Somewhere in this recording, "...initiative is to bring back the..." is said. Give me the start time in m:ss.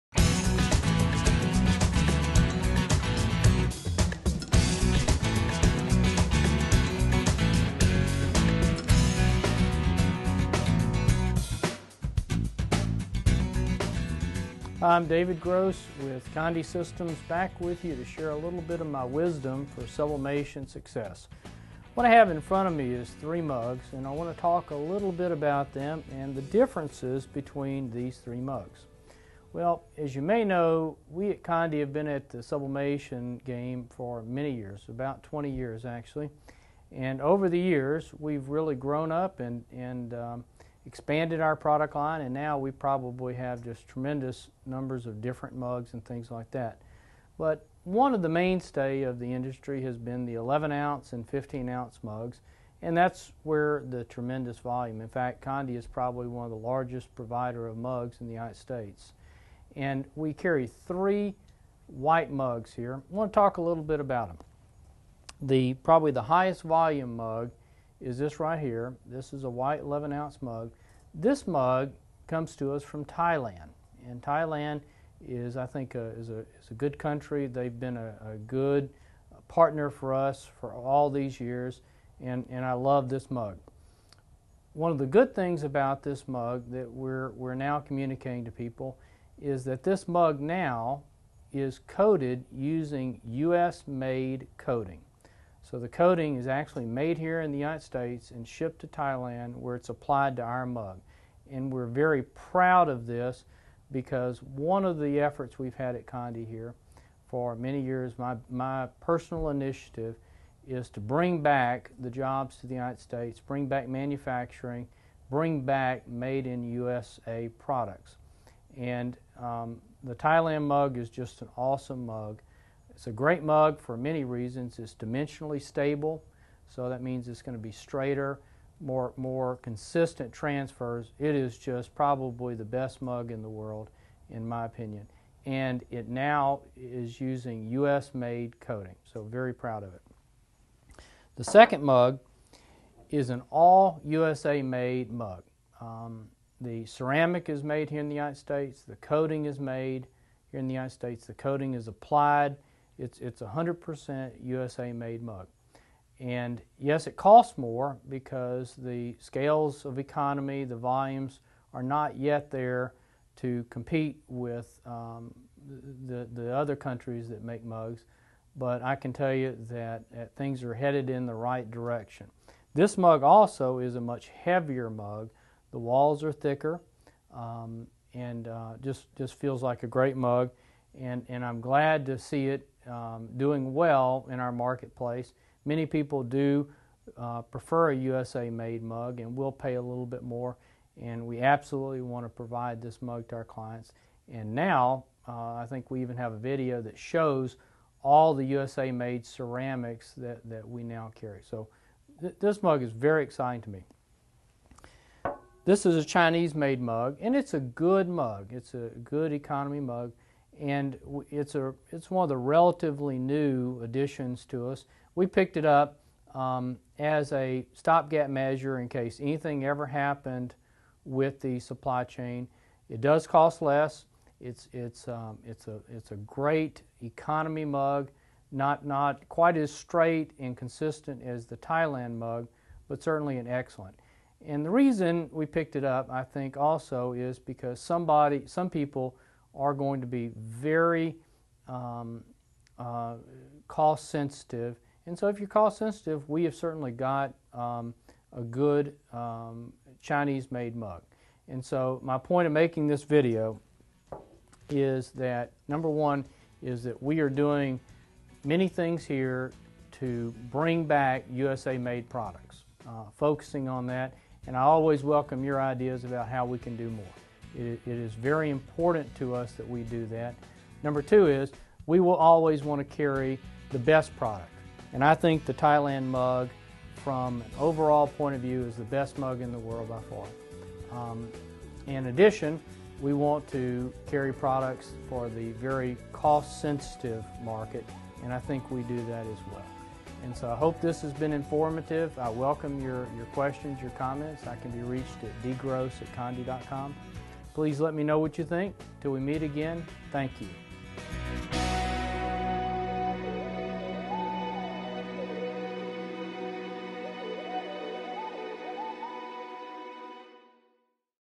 1:49.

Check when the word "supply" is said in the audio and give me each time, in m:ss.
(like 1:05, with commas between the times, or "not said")
3:41.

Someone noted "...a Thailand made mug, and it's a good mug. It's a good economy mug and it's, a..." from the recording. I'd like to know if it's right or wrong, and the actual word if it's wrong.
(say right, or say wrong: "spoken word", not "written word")
wrong: "Chinese", not "Thailand".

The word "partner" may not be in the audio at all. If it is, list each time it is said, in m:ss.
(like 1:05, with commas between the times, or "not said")
1:19.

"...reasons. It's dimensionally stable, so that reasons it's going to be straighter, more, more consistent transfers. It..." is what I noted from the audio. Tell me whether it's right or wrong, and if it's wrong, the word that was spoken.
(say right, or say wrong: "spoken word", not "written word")
wrong: "means", not "reasons".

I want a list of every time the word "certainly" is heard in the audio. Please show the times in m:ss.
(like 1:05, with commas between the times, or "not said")
3:53, 4:06.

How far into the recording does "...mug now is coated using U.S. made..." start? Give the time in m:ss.
1:30.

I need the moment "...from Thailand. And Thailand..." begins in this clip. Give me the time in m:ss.
1:12.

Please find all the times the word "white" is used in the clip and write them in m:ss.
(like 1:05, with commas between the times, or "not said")
1:01, 1:09.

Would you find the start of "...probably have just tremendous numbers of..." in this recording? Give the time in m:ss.
0:42.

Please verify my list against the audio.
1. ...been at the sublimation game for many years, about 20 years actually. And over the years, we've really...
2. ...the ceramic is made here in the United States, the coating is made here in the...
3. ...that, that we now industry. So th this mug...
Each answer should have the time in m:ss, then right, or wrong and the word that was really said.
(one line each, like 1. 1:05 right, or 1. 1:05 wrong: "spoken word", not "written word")
1. 0:31 right
2. 2:26 right
3. 3:20 wrong: "carry", not "industry".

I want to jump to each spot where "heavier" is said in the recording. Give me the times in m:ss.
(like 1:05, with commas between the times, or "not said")
2:54.